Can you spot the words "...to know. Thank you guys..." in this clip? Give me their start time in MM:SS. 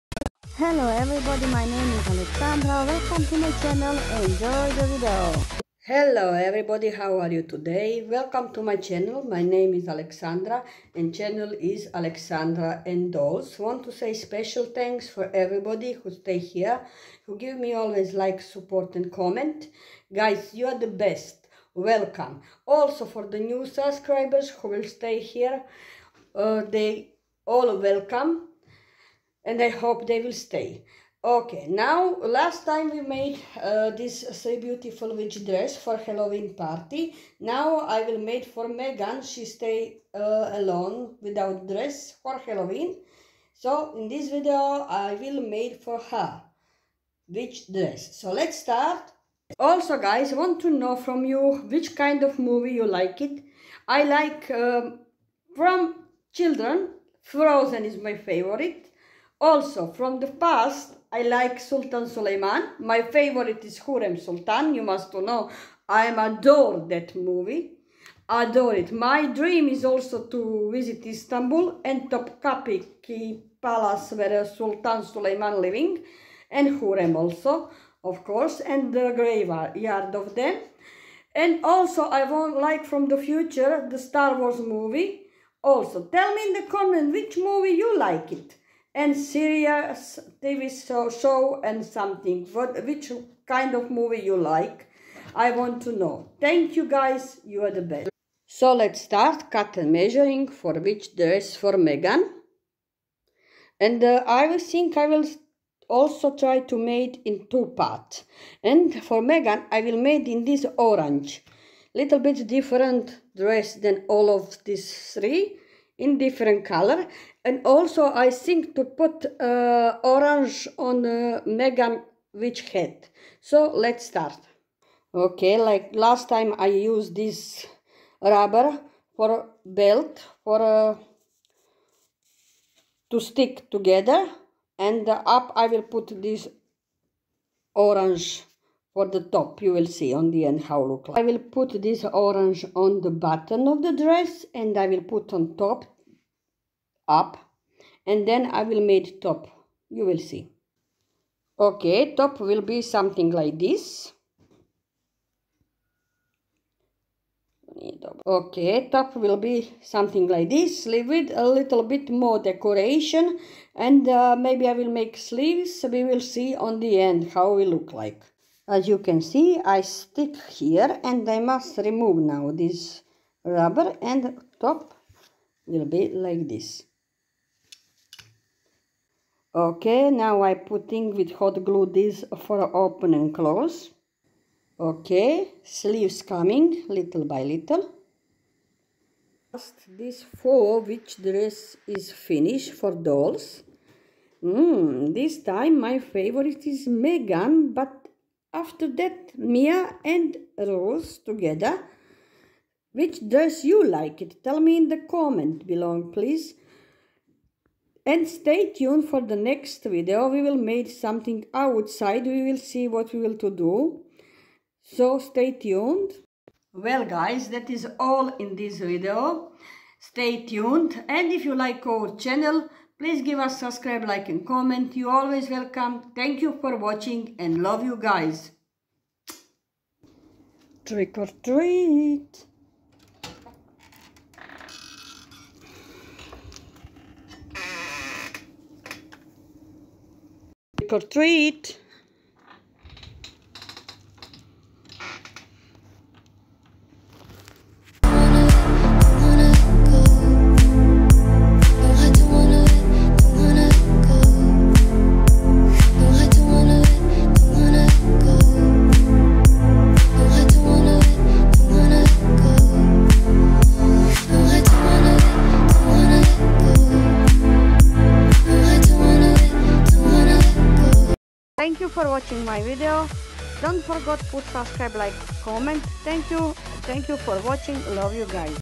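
01:35.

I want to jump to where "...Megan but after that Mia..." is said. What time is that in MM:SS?
03:16.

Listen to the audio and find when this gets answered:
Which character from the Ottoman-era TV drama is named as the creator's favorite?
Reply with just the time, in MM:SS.
01:03.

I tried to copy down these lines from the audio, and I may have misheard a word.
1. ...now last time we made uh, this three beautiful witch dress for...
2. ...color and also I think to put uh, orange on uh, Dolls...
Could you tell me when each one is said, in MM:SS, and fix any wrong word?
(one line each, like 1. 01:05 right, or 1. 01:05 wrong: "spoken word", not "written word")
1. 00:31 right
2. 01:56 wrong: "Megan", not "Dolls".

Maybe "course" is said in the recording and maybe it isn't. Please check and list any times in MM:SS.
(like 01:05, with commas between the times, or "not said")
01:18.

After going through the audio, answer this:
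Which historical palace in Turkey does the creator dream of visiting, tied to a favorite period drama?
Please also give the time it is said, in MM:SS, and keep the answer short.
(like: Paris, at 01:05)
Topkapi Palace, at 01:12.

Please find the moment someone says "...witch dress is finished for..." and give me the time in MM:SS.
03:10.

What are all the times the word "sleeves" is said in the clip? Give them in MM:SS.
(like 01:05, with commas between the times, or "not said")
02:40, 02:45, 03:05.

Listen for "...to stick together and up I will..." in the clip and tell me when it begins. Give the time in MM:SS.
02:13.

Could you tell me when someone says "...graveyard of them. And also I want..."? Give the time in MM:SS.
01:19.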